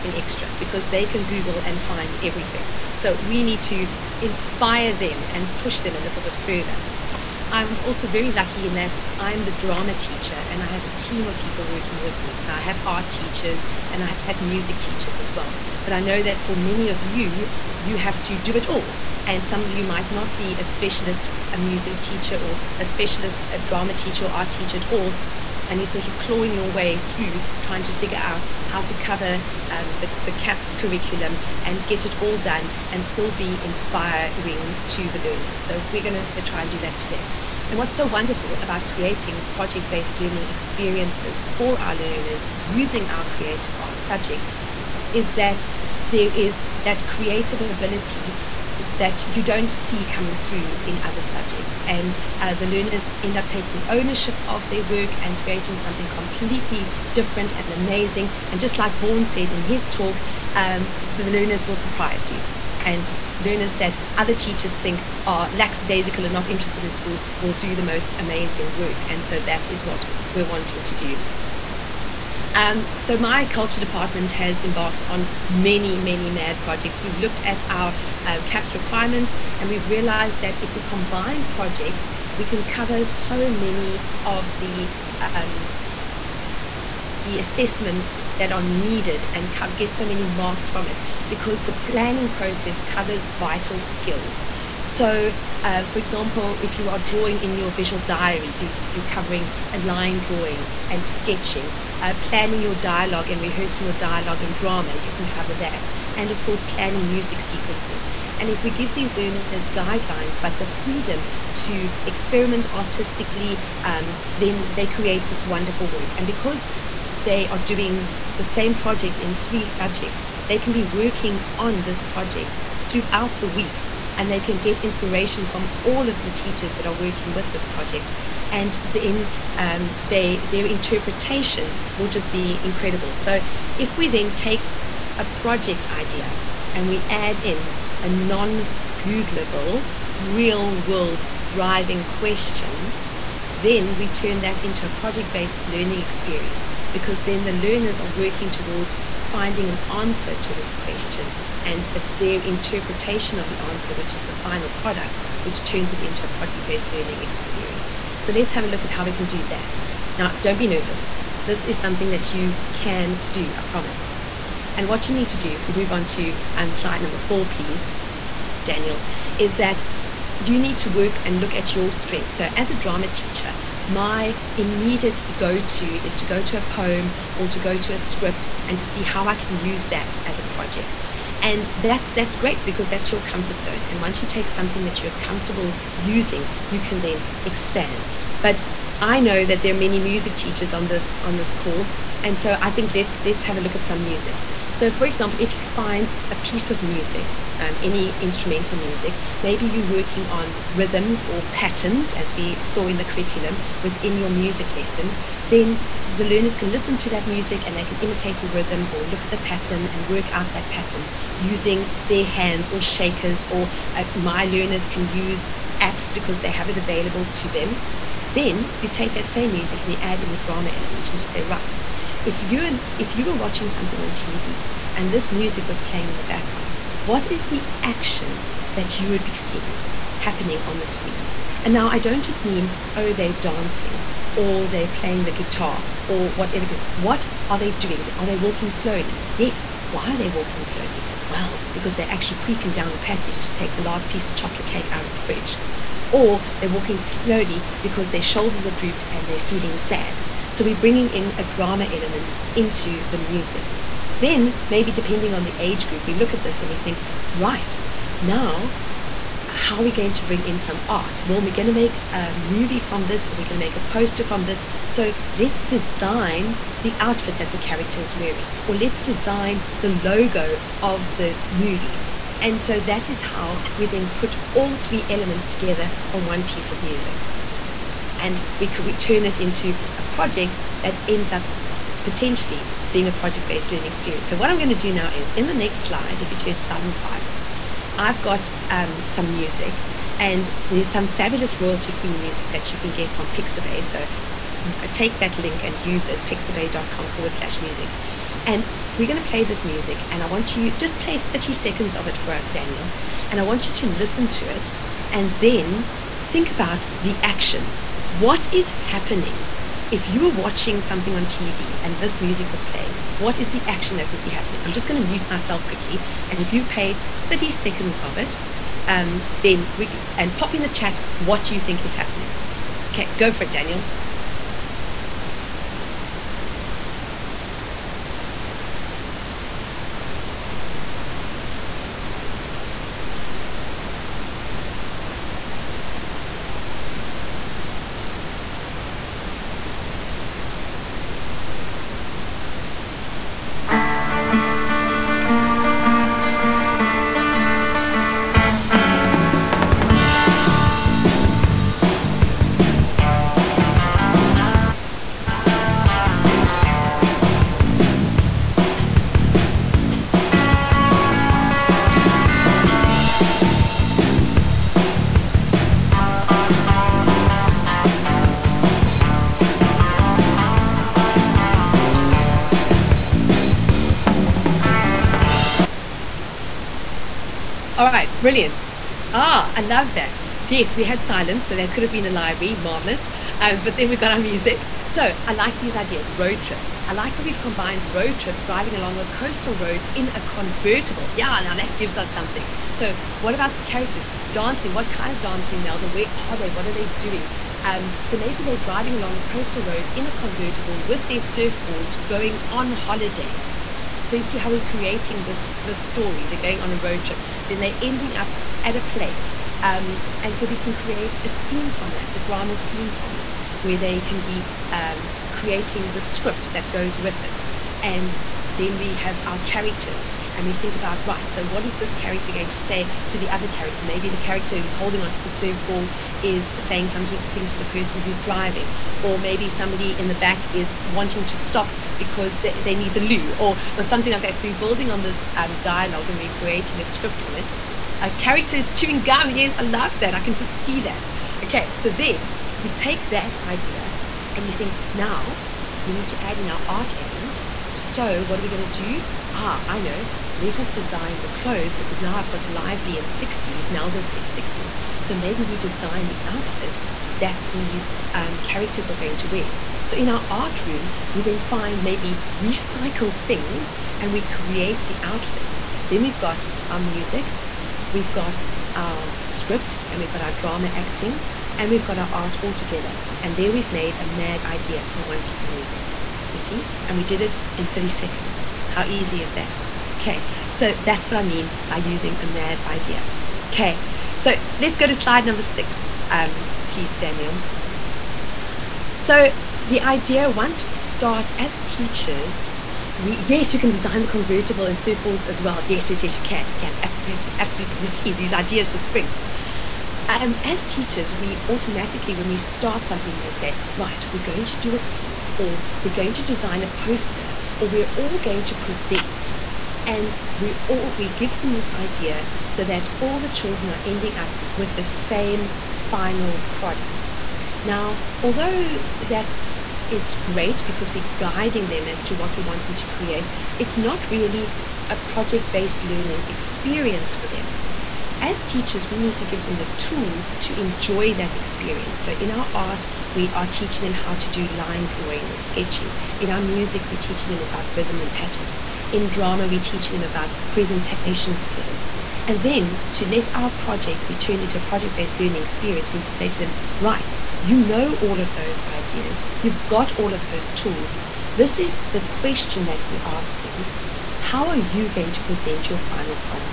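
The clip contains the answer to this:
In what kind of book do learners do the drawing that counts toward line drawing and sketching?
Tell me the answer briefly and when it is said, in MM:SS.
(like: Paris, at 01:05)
visual diary, at 01:37.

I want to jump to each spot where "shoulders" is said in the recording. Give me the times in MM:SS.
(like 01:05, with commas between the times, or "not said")
04:08.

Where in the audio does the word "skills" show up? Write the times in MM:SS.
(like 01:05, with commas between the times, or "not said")
01:33, 09:01.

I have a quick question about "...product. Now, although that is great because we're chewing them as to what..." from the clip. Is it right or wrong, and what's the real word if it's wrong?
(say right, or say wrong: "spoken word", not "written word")
wrong: "guiding", not "chewing".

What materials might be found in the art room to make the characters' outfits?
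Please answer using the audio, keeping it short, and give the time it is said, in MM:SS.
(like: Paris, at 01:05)
recycled things, at 07:42.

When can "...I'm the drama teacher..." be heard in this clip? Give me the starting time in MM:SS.
00:09.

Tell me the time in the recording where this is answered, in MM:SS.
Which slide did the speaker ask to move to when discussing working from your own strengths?
02:46.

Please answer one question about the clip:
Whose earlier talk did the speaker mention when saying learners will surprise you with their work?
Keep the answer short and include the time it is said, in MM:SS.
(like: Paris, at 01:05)
Vaughan, at 00:58.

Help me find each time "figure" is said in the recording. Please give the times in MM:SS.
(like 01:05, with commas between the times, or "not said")
00:27.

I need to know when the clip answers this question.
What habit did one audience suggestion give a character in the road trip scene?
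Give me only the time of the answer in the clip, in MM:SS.
07:18.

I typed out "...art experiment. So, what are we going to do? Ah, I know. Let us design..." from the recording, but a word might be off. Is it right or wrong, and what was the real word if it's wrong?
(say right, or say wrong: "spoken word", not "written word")
wrong: "element", not "experiment".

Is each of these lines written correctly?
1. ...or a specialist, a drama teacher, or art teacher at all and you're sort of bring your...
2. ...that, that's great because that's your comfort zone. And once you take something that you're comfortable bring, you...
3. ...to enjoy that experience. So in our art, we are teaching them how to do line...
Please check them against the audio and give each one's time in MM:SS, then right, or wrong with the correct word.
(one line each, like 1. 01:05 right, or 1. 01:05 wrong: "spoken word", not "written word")
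1. 00:22 wrong: "clawing", not "bring"
2. 03:01 wrong: "using", not "bring"
3. 08:50 right.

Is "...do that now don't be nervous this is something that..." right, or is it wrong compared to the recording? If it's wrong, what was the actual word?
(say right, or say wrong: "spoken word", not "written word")
right.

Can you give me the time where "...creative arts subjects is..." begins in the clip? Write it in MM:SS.
00:43.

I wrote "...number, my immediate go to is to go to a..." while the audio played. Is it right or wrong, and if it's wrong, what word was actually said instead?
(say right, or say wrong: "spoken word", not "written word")
wrong: "teacher", not "number".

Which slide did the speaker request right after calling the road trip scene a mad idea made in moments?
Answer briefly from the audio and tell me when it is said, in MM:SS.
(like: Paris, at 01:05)
slide 6, at 08:04.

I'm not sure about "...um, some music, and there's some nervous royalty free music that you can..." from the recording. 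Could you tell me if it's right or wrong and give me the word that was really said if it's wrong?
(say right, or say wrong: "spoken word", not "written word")
wrong: "fabulous", not "nervous".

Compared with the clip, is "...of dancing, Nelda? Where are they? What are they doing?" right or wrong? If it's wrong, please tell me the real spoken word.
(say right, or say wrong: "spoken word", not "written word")
right.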